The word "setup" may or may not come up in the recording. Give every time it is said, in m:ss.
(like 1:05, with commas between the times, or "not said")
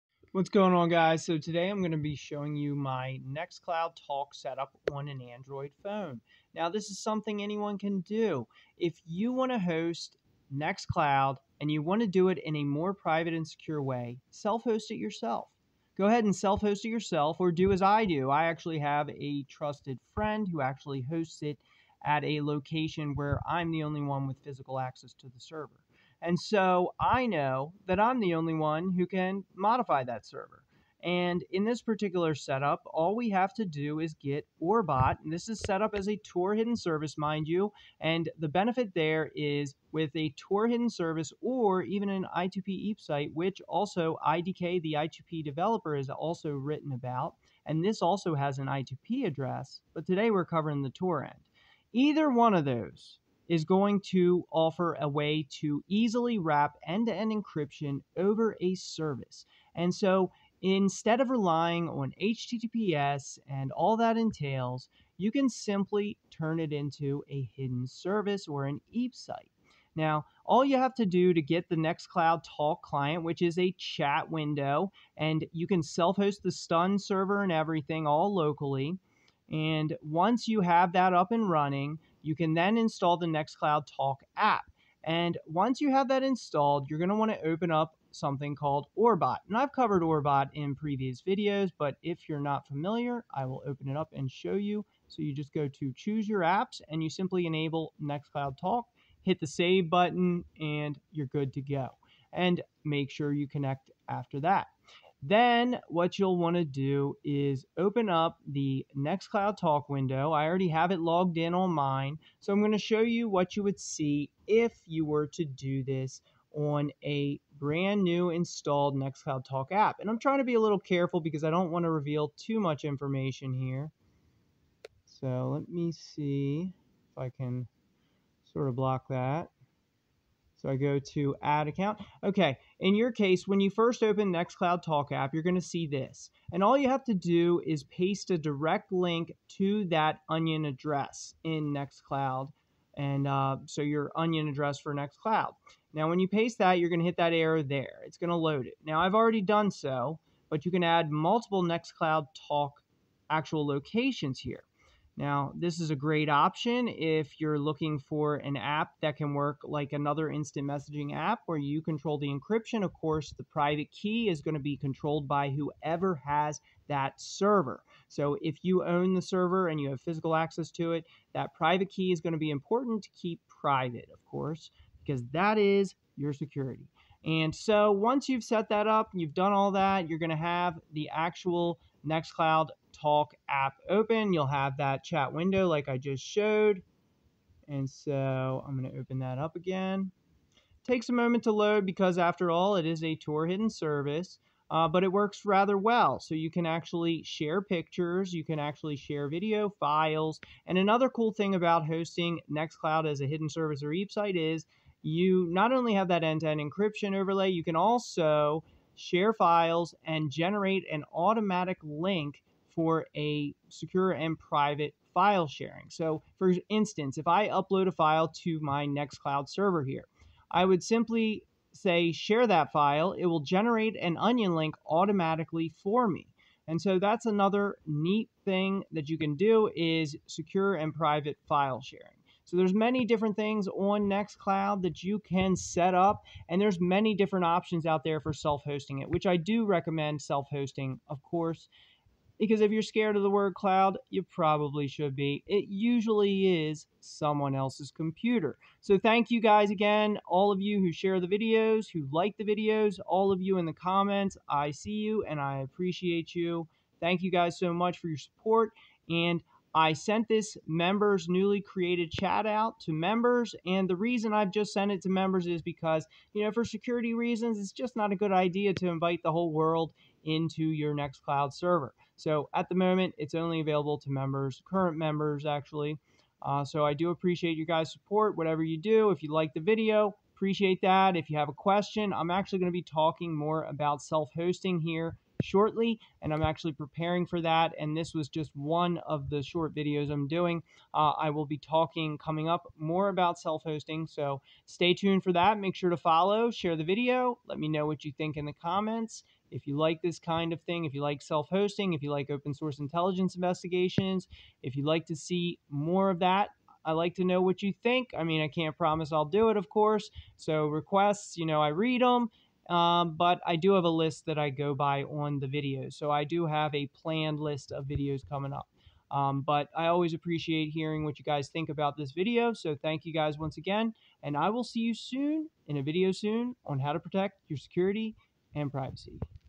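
0:04, 0:32.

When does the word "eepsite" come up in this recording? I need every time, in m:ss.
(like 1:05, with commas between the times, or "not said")
0:42, 1:08.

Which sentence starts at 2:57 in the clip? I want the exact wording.
And so, once you've set that up, you've done all that, you're going to have the actual Nextcloud Talk app open.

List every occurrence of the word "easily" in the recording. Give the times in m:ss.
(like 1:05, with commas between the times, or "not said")
0:55.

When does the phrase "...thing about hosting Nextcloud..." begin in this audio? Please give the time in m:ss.
3:21.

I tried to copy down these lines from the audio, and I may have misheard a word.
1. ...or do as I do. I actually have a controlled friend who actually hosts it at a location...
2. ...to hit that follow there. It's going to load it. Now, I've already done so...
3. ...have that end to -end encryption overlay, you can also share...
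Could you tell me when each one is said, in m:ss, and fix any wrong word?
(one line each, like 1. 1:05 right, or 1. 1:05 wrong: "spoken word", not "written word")
1. 0:17 wrong: "trusted", not "controlled"
2. 2:26 wrong: "arrow", not "follow"
3. 3:25 right.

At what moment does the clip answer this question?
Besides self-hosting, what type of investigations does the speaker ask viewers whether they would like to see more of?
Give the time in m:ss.
5:02.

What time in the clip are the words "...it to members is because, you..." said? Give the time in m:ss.
4:24.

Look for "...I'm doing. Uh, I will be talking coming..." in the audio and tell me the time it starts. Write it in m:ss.
4:50.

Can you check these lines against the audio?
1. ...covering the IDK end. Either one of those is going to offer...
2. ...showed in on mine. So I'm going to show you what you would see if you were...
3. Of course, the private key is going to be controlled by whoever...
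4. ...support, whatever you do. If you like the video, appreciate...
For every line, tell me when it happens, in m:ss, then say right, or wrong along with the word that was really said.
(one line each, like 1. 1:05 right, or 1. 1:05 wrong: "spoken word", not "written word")
1. 0:50 wrong: "Tor", not "IDK"
2. 1:50 wrong: "logged", not "showed"
3. 2:42 right
4. 4:37 right.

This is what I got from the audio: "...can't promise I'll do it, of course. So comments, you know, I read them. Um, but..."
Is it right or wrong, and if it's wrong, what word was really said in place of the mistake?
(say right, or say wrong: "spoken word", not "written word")
wrong: "requests", not "comments".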